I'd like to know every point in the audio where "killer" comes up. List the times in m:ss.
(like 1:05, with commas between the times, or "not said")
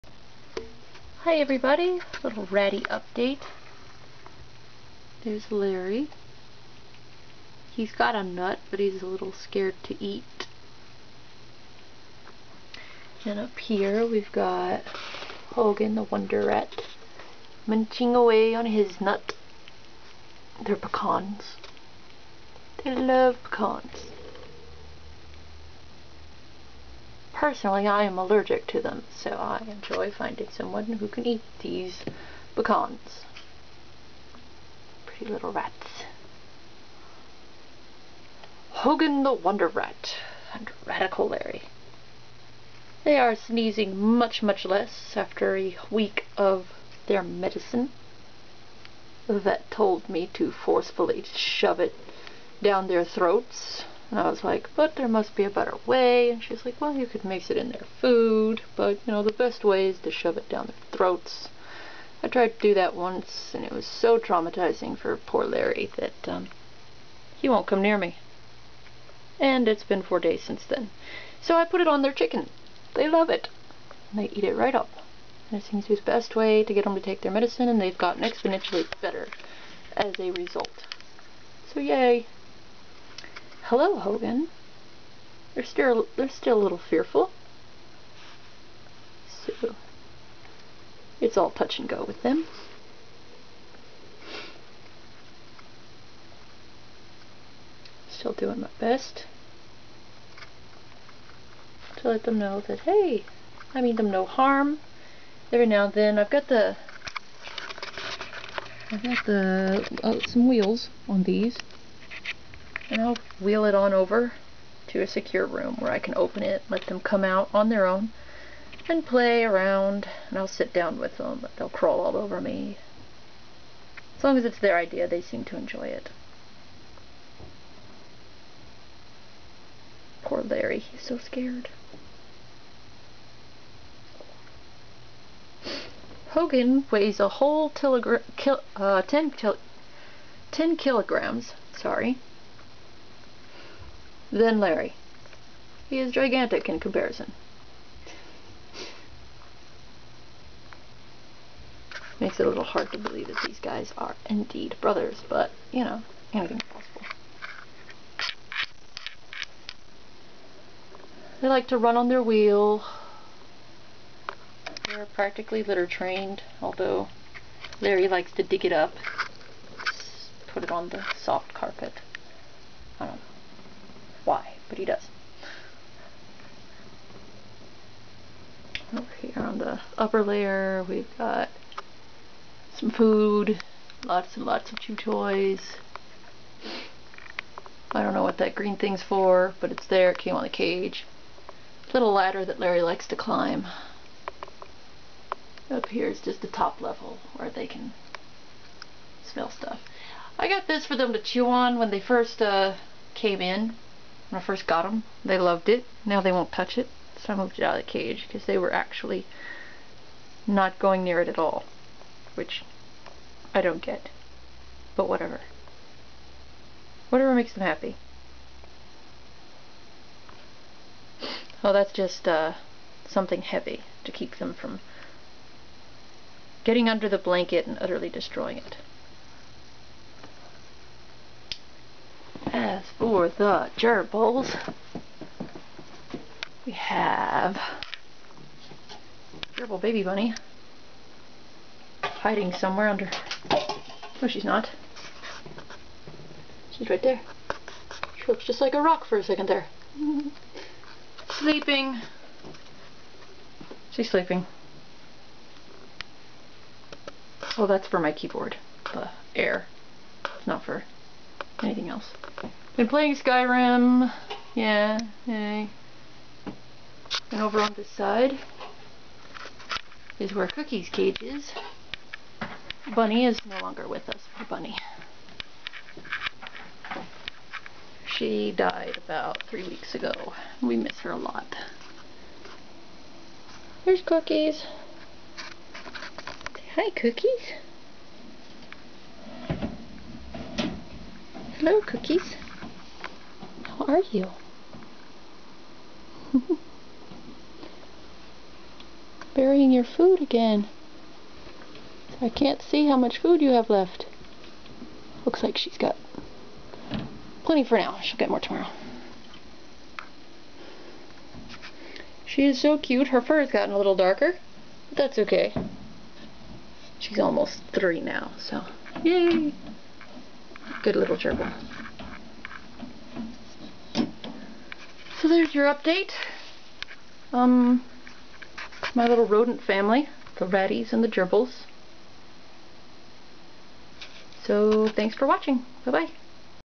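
not said.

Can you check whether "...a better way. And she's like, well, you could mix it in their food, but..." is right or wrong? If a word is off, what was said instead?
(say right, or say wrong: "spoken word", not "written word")
right.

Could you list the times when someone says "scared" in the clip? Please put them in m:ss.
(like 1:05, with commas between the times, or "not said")
0:09, 2:11.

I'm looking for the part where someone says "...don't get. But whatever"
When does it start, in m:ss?
3:33.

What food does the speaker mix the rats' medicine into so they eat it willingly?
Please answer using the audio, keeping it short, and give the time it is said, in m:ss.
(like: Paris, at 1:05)
Chicken, at 1:12.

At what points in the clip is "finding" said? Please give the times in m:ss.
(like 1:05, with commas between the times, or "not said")
0:30.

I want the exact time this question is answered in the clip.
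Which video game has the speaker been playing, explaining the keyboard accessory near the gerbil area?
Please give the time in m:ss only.
4:23.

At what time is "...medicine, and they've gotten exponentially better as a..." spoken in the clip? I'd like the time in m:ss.
1:17.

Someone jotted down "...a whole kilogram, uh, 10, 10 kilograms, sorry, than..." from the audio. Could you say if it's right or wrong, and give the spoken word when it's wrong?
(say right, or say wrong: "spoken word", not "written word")
right.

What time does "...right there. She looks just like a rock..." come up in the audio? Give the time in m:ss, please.
4:06.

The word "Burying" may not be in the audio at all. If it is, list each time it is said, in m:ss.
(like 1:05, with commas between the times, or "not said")
4:59.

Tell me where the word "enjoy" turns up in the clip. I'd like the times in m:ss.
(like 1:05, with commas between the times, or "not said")
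0:29, 2:05.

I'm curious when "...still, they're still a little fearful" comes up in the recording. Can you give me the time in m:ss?
1:25.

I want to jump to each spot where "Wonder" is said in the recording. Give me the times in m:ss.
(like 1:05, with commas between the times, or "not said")
0:16, 0:39.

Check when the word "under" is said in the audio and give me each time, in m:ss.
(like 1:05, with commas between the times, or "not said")
3:46, 4:02.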